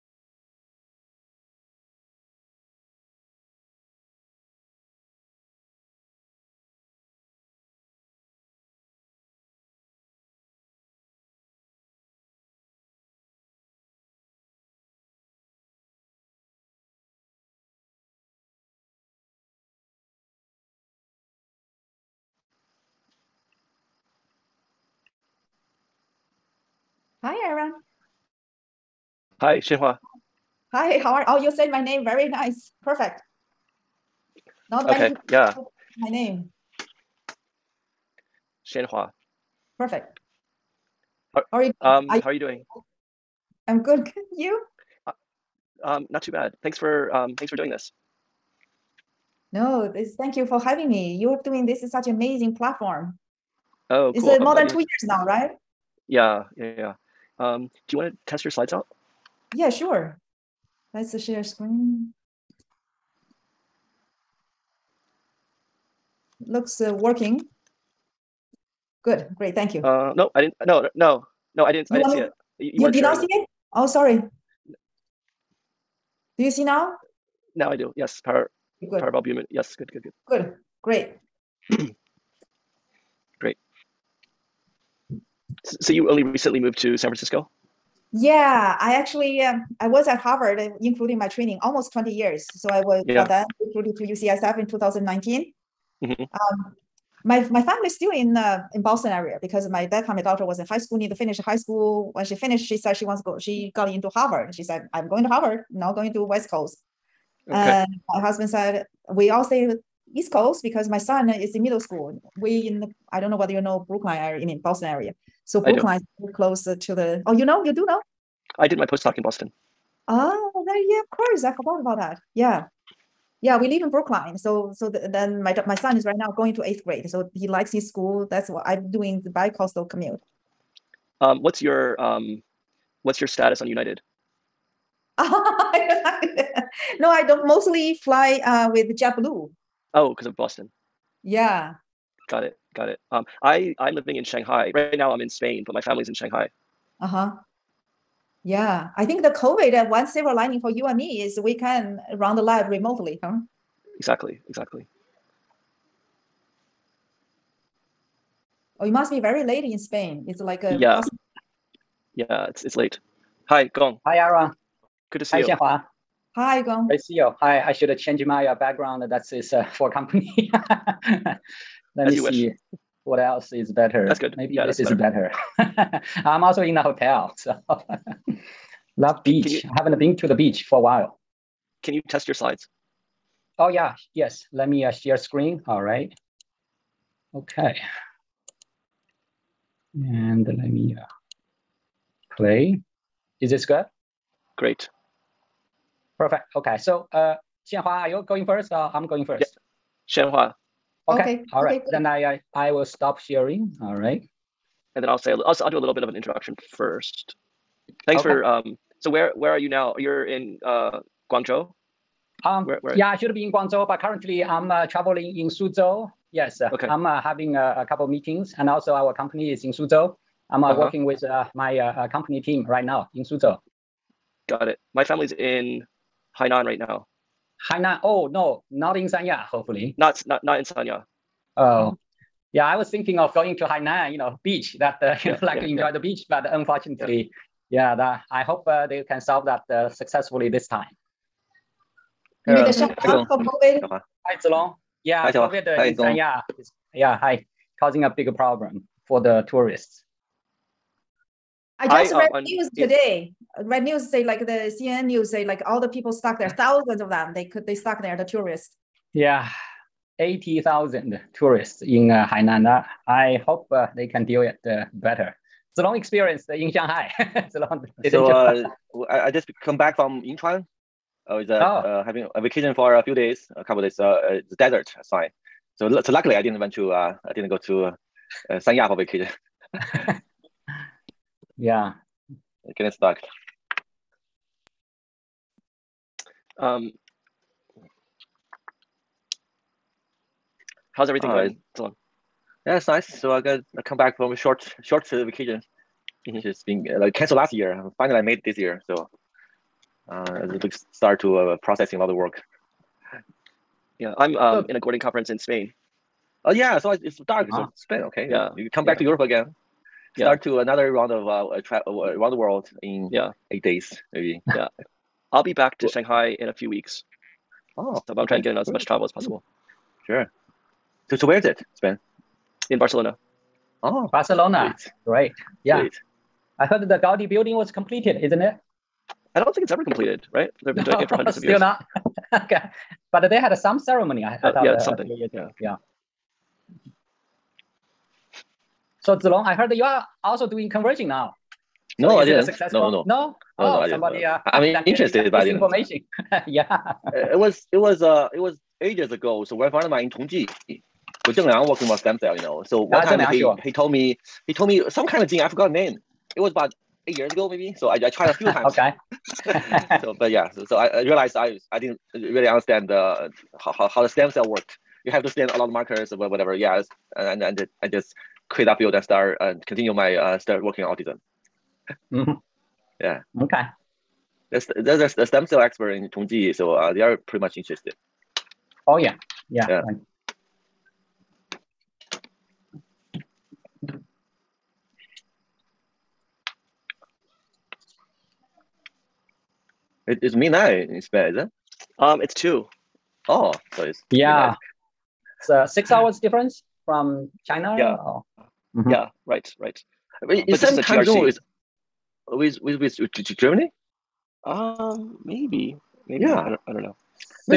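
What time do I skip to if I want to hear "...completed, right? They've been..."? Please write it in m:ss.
5:29.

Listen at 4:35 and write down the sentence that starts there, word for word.
So, so luckily I didn't went to, uh, I didn't go to uh, Sanya for vacation.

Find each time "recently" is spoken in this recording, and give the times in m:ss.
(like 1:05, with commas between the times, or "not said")
1:26.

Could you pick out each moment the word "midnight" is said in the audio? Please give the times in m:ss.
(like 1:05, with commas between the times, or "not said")
6:30, 6:34.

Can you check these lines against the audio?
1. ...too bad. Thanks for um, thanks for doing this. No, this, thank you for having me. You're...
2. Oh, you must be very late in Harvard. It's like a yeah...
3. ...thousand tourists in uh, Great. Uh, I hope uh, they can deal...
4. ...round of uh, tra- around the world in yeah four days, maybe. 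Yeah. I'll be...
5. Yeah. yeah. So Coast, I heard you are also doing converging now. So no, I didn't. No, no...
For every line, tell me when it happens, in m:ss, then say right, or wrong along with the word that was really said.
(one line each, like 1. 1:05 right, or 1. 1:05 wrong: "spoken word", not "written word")
1. 0:46 right
2. 2:38 wrong: "Spain", not "Harvard"
3. 4:20 wrong: "Hainan", not "Great"
4. 5:10 wrong: "eight", not "four"
5. 5:35 wrong: "Zilong", not "Coast".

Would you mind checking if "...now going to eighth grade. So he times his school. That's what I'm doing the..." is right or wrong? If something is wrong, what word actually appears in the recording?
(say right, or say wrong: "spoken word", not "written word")
wrong: "likes", not "times".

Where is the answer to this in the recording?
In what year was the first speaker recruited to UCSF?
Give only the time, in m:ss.
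1:34.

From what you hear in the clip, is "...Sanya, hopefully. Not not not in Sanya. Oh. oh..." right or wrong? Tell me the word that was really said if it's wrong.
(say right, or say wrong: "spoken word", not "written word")
right.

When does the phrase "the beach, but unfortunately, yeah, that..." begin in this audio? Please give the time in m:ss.
3:55.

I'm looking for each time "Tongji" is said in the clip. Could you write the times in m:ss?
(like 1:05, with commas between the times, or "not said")
5:50, 6:16.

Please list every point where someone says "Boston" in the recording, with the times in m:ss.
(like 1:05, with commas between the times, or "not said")
1:38, 1:54, 1:59, 2:20.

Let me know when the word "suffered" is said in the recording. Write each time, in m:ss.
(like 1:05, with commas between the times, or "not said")
not said.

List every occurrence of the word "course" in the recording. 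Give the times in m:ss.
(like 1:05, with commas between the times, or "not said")
2:01.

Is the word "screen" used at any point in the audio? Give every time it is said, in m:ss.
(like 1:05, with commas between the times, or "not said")
1:01, 3:05.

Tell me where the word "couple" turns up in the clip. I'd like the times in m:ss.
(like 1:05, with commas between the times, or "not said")
3:37, 4:33.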